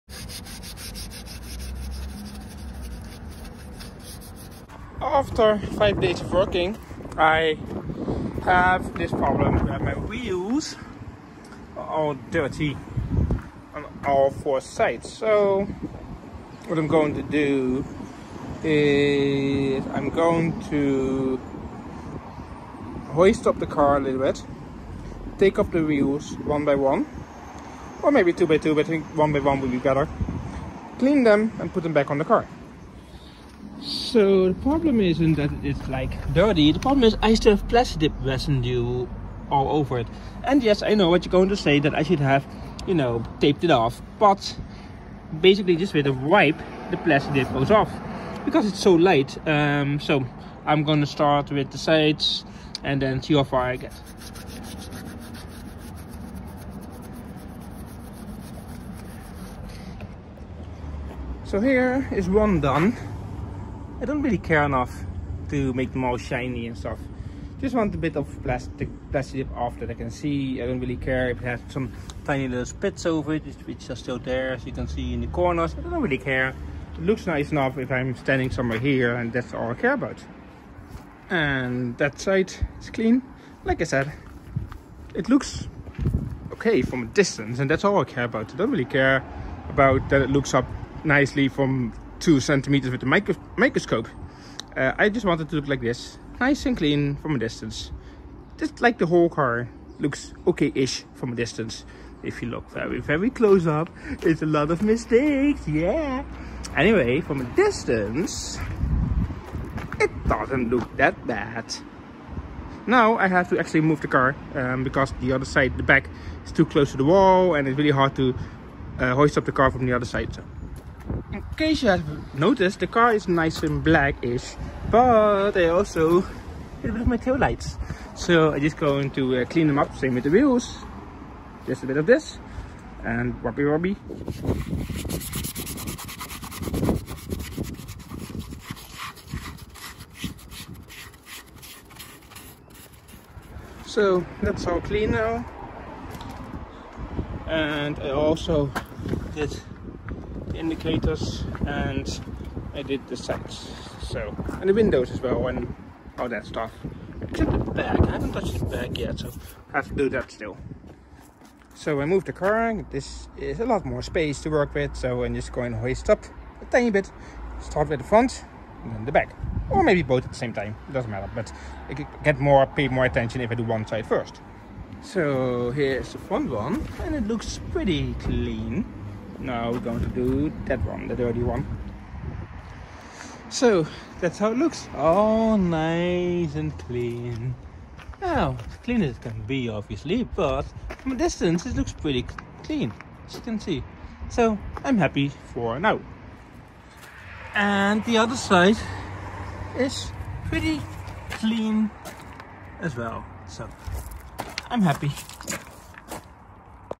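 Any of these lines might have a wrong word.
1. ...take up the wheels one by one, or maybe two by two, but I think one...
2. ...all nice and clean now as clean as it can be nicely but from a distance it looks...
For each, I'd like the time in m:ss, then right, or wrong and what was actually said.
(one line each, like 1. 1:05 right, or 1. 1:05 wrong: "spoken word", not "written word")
1. 0:25 right
2. 3:04 wrong: "obviously", not "nicely".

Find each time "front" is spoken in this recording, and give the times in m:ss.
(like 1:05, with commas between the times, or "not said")
2:48, 2:56.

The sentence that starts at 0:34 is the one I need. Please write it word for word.
So the problem isn't that it's like dirty, the problem is I still have plastic residue all over it.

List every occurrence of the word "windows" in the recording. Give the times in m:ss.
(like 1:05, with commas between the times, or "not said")
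2:34.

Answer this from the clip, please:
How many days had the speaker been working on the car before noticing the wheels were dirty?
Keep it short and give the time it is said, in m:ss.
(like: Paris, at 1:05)
5, at 0:05.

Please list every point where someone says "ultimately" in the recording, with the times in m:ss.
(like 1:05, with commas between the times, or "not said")
not said.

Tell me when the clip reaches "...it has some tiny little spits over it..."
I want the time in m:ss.
1:11.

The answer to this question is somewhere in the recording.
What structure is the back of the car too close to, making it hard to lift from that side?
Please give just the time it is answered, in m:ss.
1:56.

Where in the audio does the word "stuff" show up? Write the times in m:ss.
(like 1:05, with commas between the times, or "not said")
1:06, 2:36.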